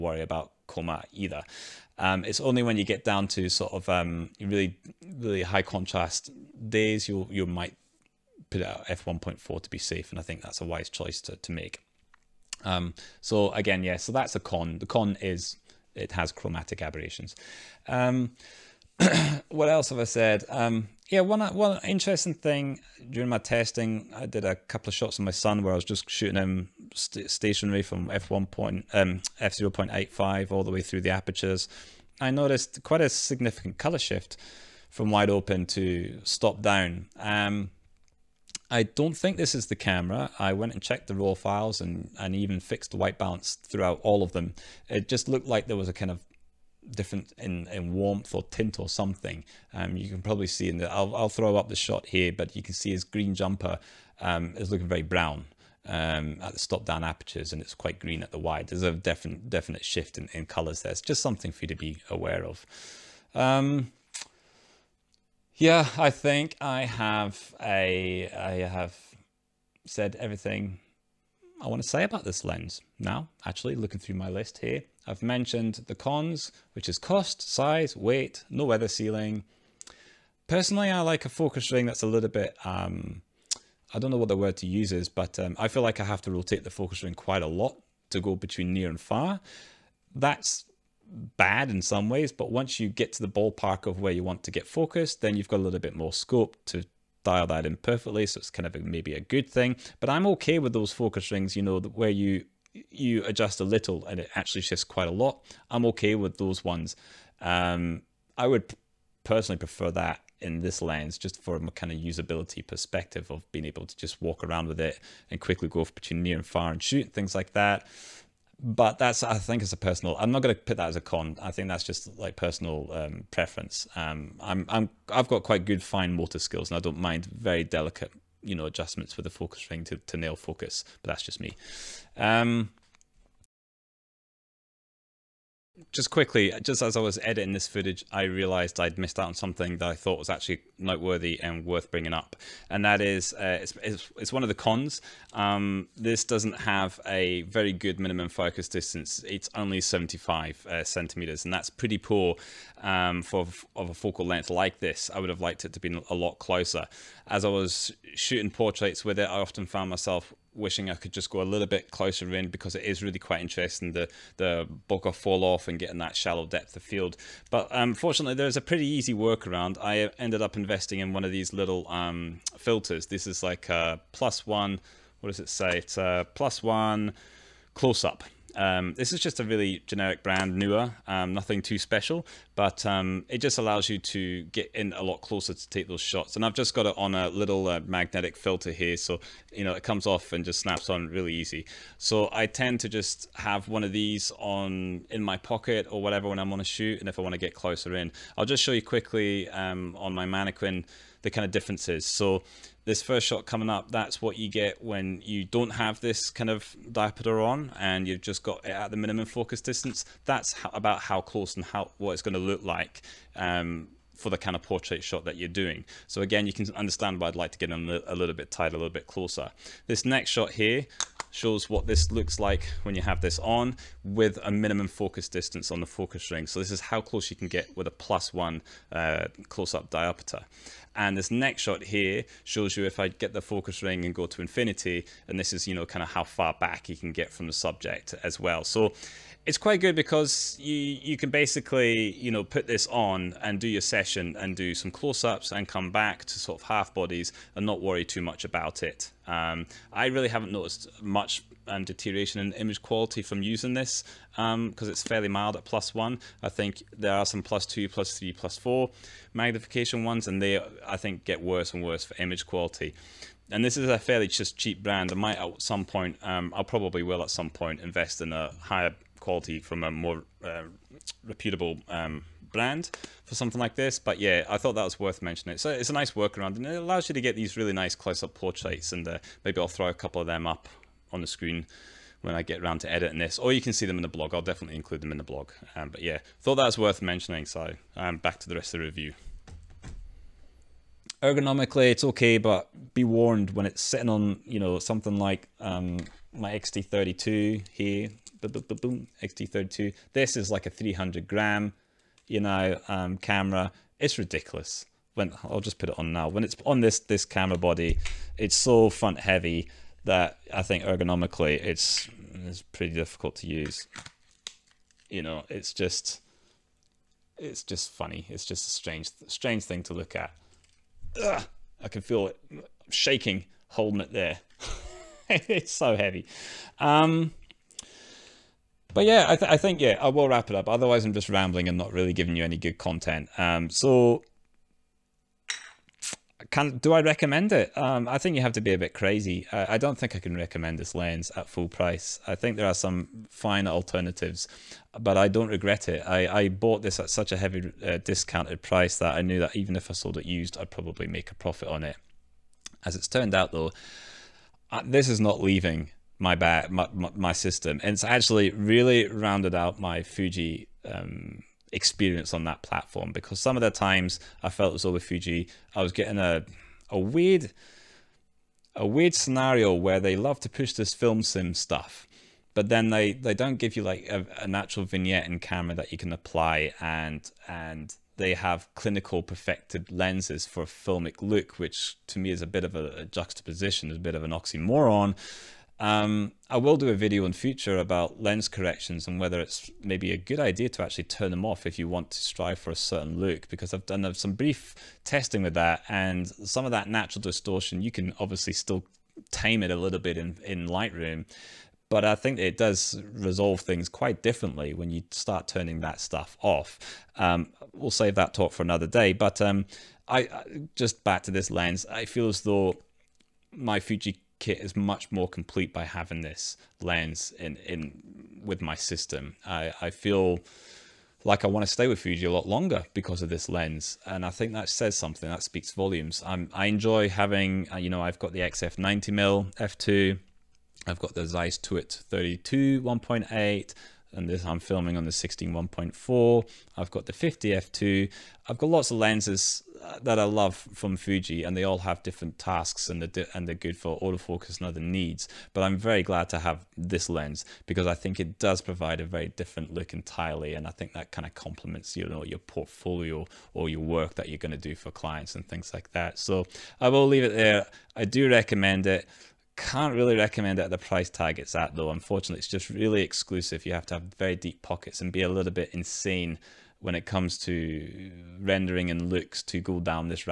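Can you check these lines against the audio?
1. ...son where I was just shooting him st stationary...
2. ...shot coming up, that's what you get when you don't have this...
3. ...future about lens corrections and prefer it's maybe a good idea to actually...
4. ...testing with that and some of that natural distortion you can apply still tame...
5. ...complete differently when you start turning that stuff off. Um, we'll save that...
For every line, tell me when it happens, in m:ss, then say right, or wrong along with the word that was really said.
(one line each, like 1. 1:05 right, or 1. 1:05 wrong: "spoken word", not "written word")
1. 0:25 right
2. 3:23 right
3. 6:27 wrong: "whether", not "prefer"
4. 6:35 wrong: "obviously", not "apply"
5. 6:43 wrong: "quite", not "complete".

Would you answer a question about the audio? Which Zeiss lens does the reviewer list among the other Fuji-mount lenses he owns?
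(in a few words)
Touit 32 1.8.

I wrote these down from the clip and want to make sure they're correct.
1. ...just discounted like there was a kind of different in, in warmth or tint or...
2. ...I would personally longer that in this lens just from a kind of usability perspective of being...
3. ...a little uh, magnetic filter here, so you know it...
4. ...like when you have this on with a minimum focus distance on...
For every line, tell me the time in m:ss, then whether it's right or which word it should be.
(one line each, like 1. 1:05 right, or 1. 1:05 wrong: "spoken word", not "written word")
1. 0:45 wrong: "looked", not "discounted"
2. 1:48 wrong: "prefer", not "longer"
3. 3:07 right
4. 3:42 right.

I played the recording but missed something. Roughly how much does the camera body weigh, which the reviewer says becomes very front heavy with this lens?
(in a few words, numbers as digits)
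300 grams.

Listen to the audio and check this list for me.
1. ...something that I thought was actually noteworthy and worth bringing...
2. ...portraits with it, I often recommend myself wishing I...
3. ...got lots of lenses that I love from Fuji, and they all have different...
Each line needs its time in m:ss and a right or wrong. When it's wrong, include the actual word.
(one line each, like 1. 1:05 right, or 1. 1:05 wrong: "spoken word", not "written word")
1. 2:19 right
2. 2:38 wrong: "found", not "recommend"
3. 7:18 right.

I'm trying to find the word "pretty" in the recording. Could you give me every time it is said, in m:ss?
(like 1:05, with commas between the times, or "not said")
2:31, 2:48, 5:12.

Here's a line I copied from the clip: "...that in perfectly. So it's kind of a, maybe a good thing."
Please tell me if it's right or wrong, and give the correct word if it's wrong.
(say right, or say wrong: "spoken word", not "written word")
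right.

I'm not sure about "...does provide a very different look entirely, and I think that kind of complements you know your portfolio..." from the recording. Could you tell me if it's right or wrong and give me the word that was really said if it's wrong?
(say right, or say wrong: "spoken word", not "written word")
right.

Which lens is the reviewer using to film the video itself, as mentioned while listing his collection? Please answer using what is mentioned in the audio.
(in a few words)
16 1.4.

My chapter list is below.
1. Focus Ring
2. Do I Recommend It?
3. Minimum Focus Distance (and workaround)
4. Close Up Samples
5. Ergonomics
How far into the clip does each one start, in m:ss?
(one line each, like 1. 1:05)
1. 1:19
2. 5:33
3. 2:13
4. 4:36
5. 4:50.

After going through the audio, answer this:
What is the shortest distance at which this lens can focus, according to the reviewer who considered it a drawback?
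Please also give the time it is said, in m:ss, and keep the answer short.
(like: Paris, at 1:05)
75 centimeters, at 2:29.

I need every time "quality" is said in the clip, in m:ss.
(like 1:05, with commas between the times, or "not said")
4:12, 4:22, 4:29.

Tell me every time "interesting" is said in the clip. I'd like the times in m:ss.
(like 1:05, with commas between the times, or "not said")
0:21, 2:43.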